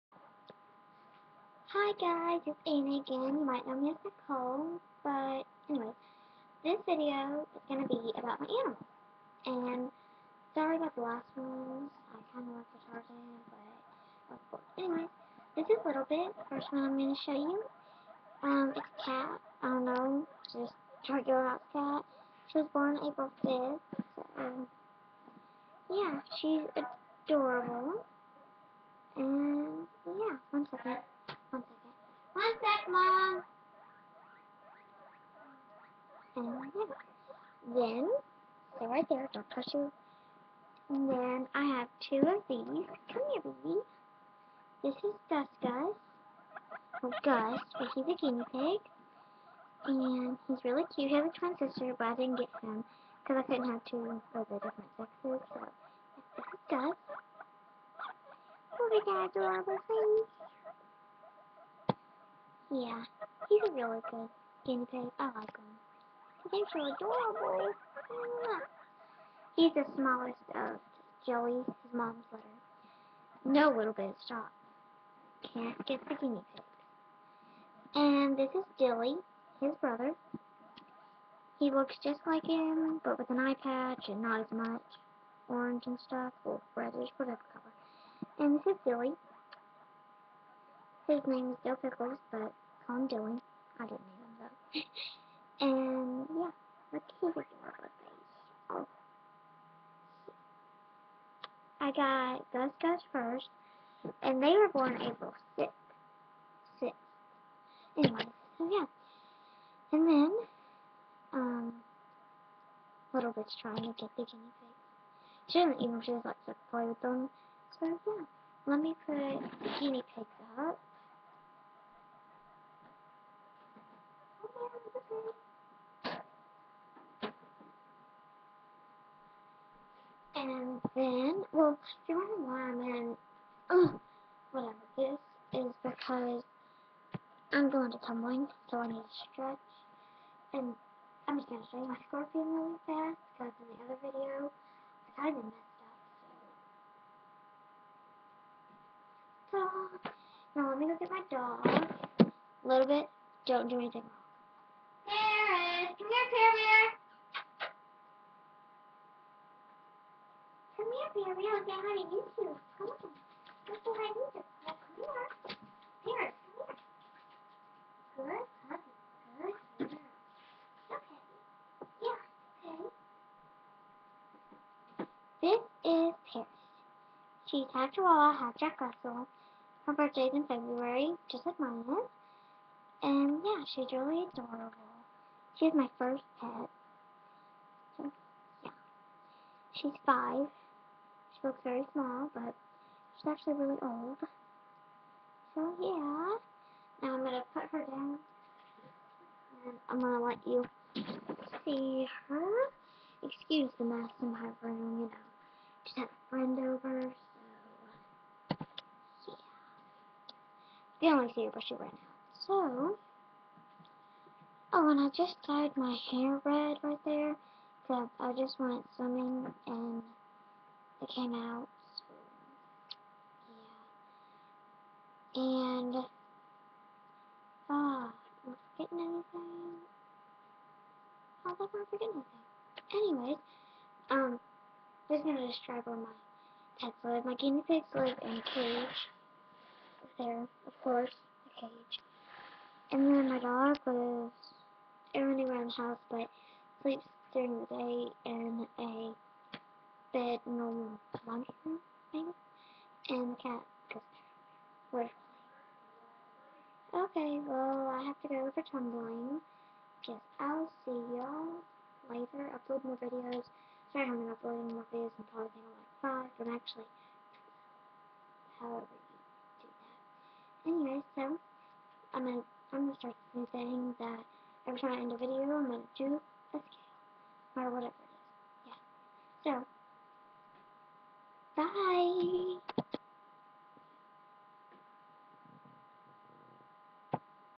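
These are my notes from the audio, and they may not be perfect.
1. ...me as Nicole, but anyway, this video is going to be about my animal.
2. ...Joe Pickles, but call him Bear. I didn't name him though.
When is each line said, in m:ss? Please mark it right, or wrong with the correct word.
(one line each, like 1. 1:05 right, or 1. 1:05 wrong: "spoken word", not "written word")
1. 0:03 right
2. 1:31 wrong: "Dylan", not "Bear".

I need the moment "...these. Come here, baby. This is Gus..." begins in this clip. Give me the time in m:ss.
0:42.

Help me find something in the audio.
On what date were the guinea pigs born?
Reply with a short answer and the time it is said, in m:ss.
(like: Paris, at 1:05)
April 6th, at 1:45.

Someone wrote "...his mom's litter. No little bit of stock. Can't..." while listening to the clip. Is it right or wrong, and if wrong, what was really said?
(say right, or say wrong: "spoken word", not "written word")
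right.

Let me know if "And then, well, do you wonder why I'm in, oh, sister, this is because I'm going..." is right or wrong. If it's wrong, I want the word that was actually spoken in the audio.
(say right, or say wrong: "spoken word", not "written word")
wrong: "whatever", not "sister".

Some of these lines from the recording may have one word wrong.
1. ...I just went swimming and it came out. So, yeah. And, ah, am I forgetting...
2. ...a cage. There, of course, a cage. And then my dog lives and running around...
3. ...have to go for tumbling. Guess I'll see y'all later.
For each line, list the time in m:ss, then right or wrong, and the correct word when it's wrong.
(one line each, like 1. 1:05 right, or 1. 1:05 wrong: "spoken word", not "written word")
1. 3:38 right
2. 3:58 right
3. 4:18 right.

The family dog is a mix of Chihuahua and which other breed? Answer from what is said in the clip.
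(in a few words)
Jack Russell.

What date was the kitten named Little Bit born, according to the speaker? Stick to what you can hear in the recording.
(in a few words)
April 5th.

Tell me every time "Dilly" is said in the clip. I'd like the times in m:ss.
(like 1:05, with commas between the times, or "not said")
1:18, 1:28.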